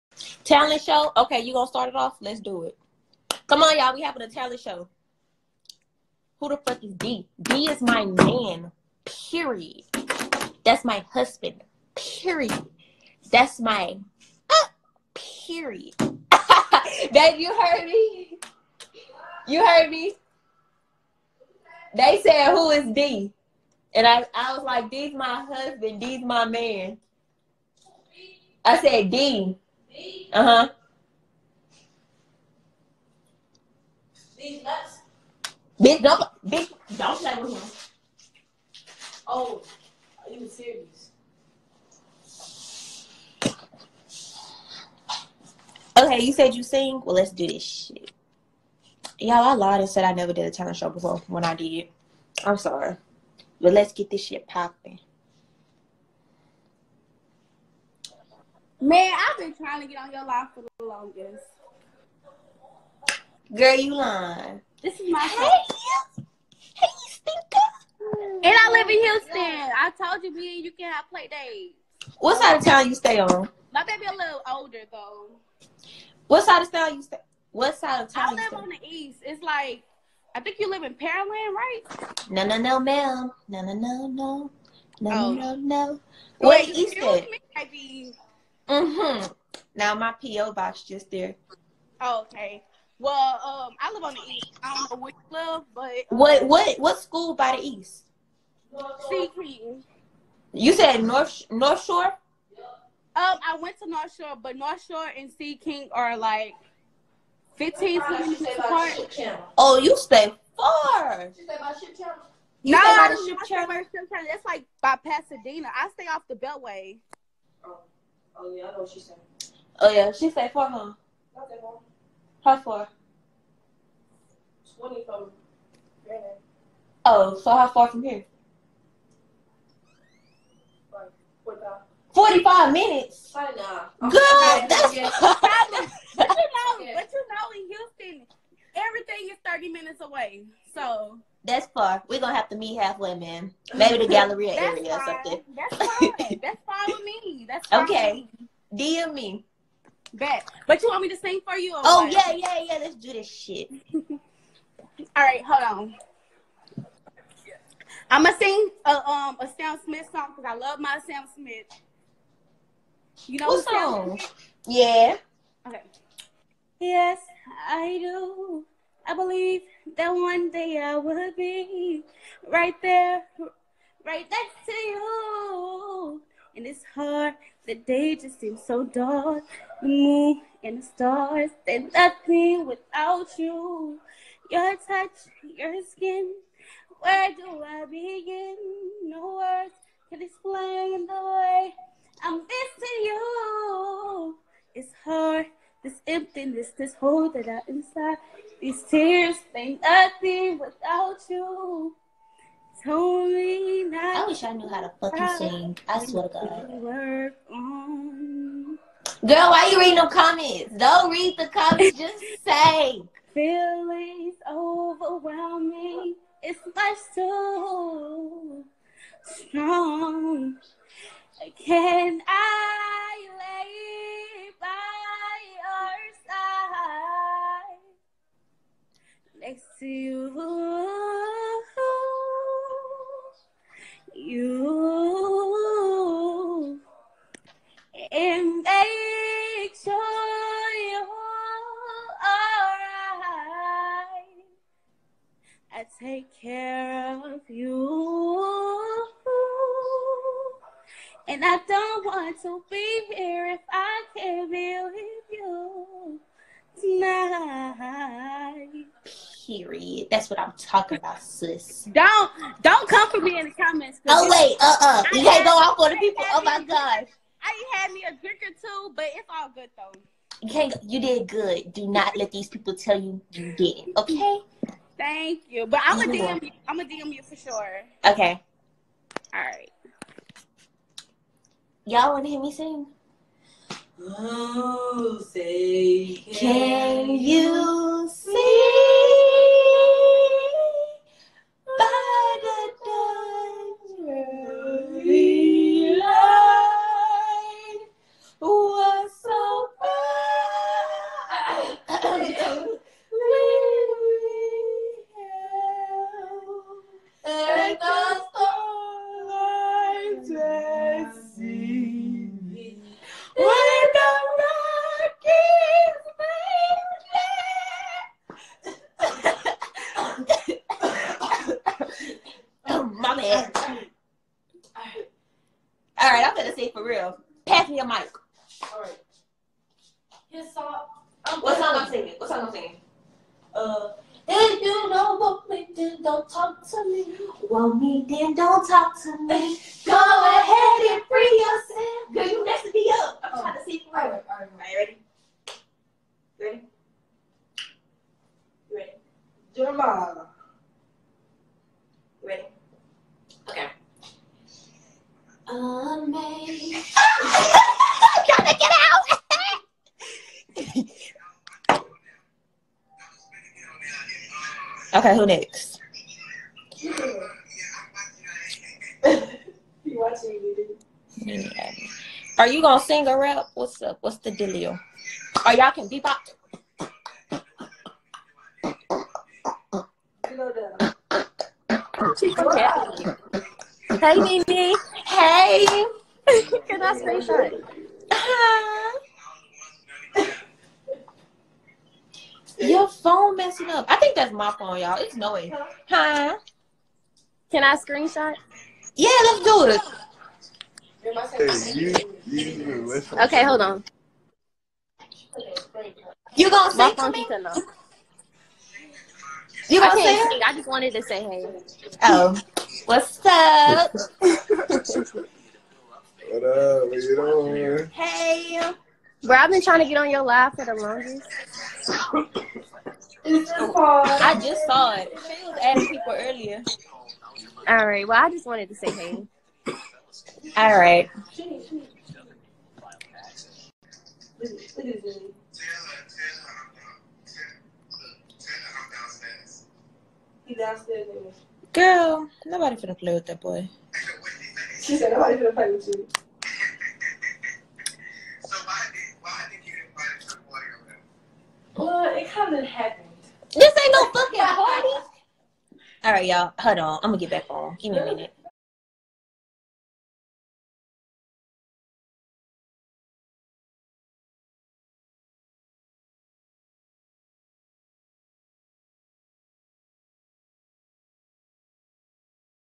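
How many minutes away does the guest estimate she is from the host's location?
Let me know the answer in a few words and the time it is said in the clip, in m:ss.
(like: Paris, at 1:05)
45, at 2:12.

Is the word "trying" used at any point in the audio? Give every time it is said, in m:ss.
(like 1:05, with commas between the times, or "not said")
0:59, 6:59.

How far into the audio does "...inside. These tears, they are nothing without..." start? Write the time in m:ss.
3:17.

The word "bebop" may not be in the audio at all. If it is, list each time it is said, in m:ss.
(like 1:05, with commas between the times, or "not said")
6:15.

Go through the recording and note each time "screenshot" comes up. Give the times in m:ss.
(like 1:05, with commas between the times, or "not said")
6:37.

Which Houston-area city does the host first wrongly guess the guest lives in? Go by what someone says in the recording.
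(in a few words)
Pearland.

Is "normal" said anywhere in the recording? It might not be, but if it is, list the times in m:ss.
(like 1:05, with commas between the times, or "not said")
not said.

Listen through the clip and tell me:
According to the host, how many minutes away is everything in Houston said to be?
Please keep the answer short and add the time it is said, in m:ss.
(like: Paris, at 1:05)
30, at 2:19.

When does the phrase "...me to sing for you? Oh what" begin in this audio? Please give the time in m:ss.
2:31.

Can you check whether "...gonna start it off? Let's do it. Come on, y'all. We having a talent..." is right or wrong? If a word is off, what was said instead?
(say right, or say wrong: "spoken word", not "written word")
right.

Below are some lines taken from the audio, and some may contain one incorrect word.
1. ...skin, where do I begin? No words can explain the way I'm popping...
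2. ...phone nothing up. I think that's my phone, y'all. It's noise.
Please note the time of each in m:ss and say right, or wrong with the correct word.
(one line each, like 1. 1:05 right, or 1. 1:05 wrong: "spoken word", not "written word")
1. 3:05 wrong: "missing", not "popping"
2. 6:32 wrong: "messing", not "nothing".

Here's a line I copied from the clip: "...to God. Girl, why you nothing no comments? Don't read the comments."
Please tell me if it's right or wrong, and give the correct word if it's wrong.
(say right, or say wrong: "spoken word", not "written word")
wrong: "reading", not "nothing".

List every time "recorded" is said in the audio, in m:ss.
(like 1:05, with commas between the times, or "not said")
not said.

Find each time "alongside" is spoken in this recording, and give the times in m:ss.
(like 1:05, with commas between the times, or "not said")
not said.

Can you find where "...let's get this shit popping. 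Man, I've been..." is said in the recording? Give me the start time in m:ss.
0:53.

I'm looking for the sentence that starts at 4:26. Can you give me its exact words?
Oh my gosh probably had me a drink or two, but it's all good though.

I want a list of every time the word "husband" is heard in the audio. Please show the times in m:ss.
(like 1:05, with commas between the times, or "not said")
0:11, 0:25.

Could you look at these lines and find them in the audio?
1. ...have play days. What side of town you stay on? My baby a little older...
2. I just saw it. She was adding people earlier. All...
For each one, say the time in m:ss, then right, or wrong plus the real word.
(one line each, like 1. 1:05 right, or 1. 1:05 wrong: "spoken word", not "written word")
1. 1:10 right
2. 7:03 right.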